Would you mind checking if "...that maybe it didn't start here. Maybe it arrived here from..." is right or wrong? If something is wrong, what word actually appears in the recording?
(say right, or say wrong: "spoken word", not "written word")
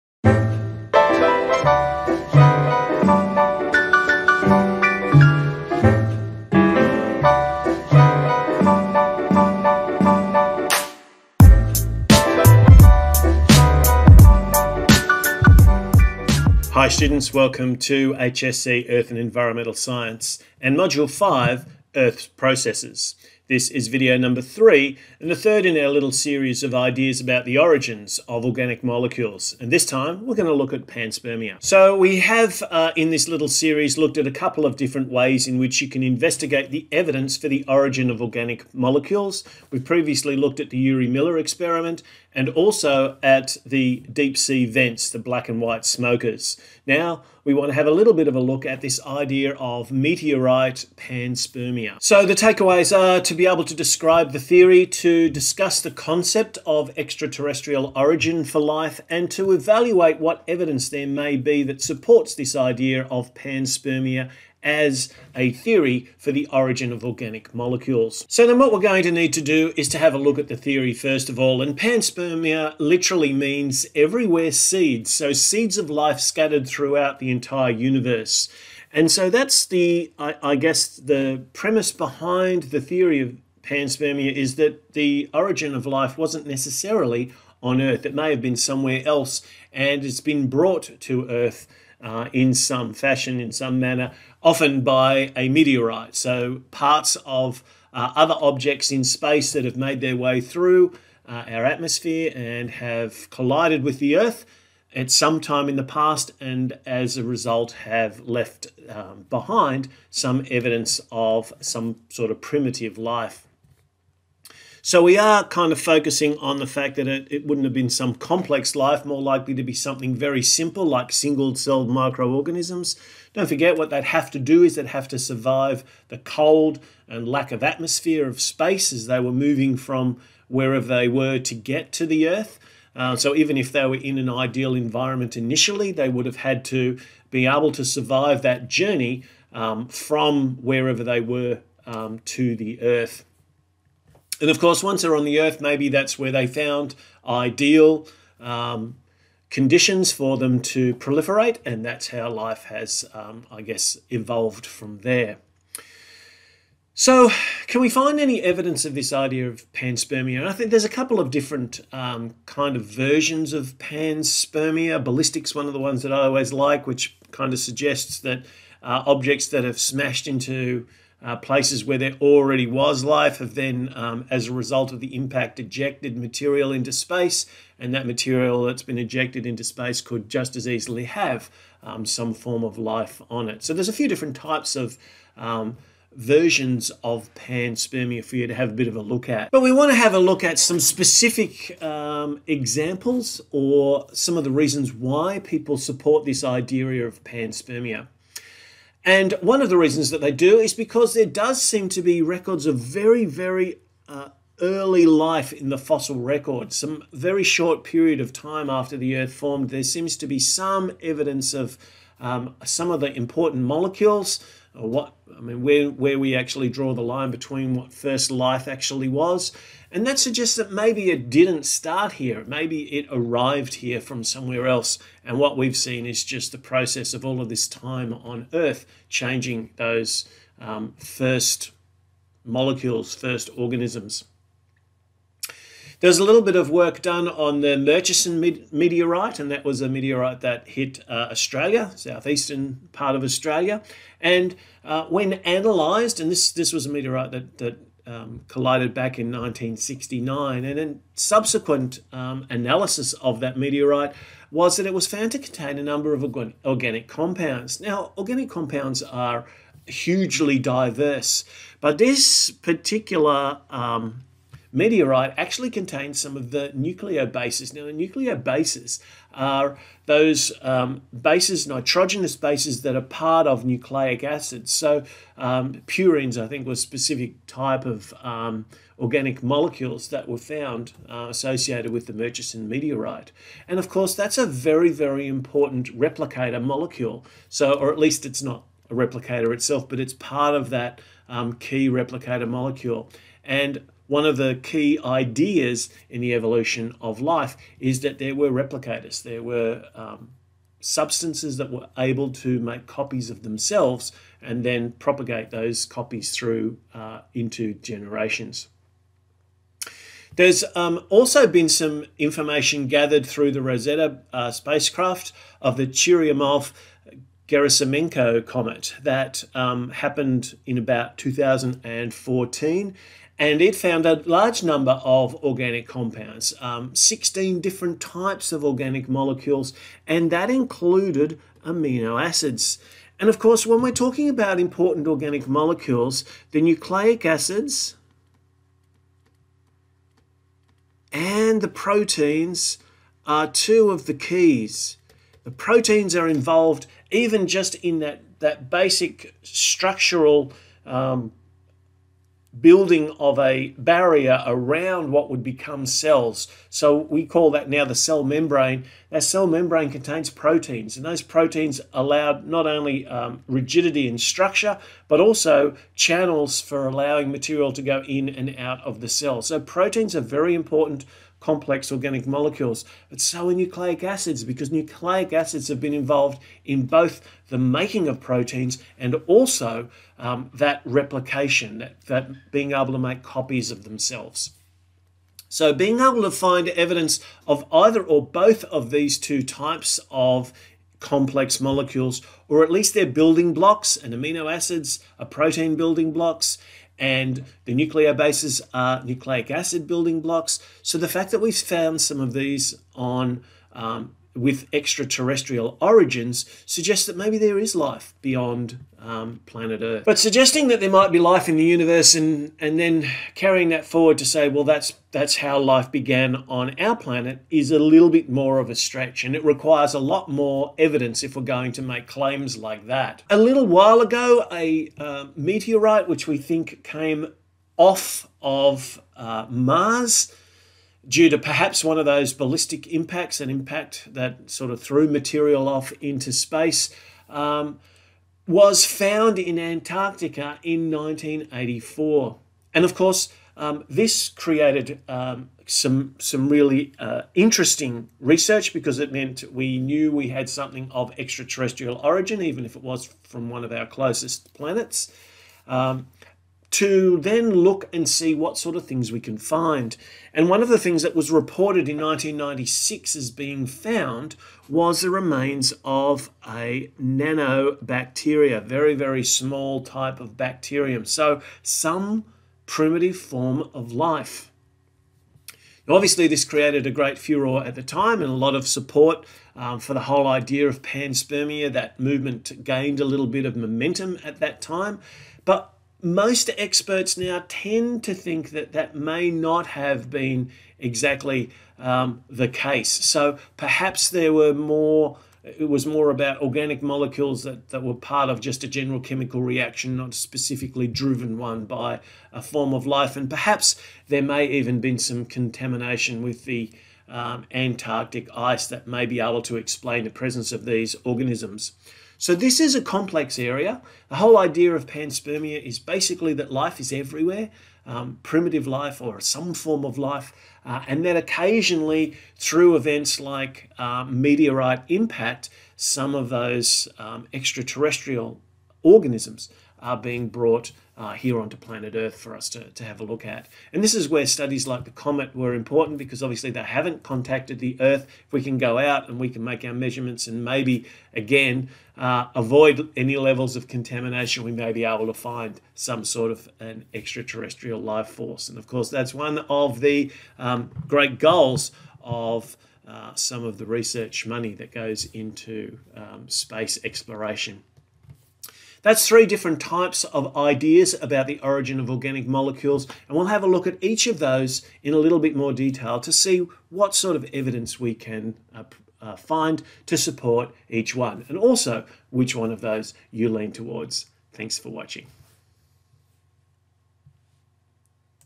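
right.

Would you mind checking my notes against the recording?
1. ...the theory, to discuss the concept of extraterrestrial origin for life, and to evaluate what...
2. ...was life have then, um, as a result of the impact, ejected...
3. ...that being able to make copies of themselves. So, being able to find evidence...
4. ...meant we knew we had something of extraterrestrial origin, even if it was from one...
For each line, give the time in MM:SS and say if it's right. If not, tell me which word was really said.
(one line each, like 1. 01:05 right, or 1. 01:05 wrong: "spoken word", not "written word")
1. 00:54 right
2. 02:52 right
3. 06:22 right
4. 07:29 right.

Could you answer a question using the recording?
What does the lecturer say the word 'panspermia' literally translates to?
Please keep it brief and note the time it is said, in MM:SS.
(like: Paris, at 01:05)
Everywhere seeds, at 01:13.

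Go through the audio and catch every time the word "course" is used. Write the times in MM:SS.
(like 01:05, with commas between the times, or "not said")
02:24, 04:43, 05:33, 07:22, 09:08.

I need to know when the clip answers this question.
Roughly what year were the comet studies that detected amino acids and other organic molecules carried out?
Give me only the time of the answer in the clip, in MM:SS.
05:21.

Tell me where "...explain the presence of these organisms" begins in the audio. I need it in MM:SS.
08:29.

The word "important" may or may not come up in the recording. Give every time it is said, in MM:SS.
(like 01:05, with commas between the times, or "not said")
03:33, 04:45, 05:34, 06:10, 08:55.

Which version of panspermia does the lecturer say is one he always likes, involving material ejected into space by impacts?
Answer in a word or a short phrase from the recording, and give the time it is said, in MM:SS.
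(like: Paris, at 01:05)
Ballistics, at 02:45.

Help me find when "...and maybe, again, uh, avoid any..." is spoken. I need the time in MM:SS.
09:00.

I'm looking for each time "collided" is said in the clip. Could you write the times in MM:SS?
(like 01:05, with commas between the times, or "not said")
01:43, 04:08.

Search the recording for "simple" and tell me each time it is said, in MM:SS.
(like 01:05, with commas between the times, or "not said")
02:00.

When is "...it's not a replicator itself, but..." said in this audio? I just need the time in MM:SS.
04:48.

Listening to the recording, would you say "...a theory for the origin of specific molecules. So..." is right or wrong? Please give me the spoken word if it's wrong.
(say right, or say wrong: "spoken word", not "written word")
wrong: "organic", not "specific".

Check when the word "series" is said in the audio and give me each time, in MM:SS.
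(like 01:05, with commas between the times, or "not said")
00:26, 00:33.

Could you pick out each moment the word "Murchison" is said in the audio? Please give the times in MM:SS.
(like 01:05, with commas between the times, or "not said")
03:57, 04:42.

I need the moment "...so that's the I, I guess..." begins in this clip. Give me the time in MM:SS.
01:19.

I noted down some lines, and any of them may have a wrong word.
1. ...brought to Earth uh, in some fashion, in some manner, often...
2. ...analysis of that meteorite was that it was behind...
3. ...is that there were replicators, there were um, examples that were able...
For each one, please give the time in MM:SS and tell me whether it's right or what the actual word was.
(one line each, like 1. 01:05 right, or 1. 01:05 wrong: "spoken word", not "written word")
1. 01:30 right
2. 04:12 wrong: "found", not "behind"
3. 04:57 wrong: "substances", not "examples".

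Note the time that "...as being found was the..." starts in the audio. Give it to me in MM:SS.
07:43.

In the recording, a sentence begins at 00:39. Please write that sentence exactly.
We previously looked at the Urey Miller experiment, and also at the deep sea vents, the black and white smokers.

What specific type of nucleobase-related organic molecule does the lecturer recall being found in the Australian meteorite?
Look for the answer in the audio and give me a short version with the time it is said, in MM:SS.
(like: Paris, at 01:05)
Purines, at 04:35.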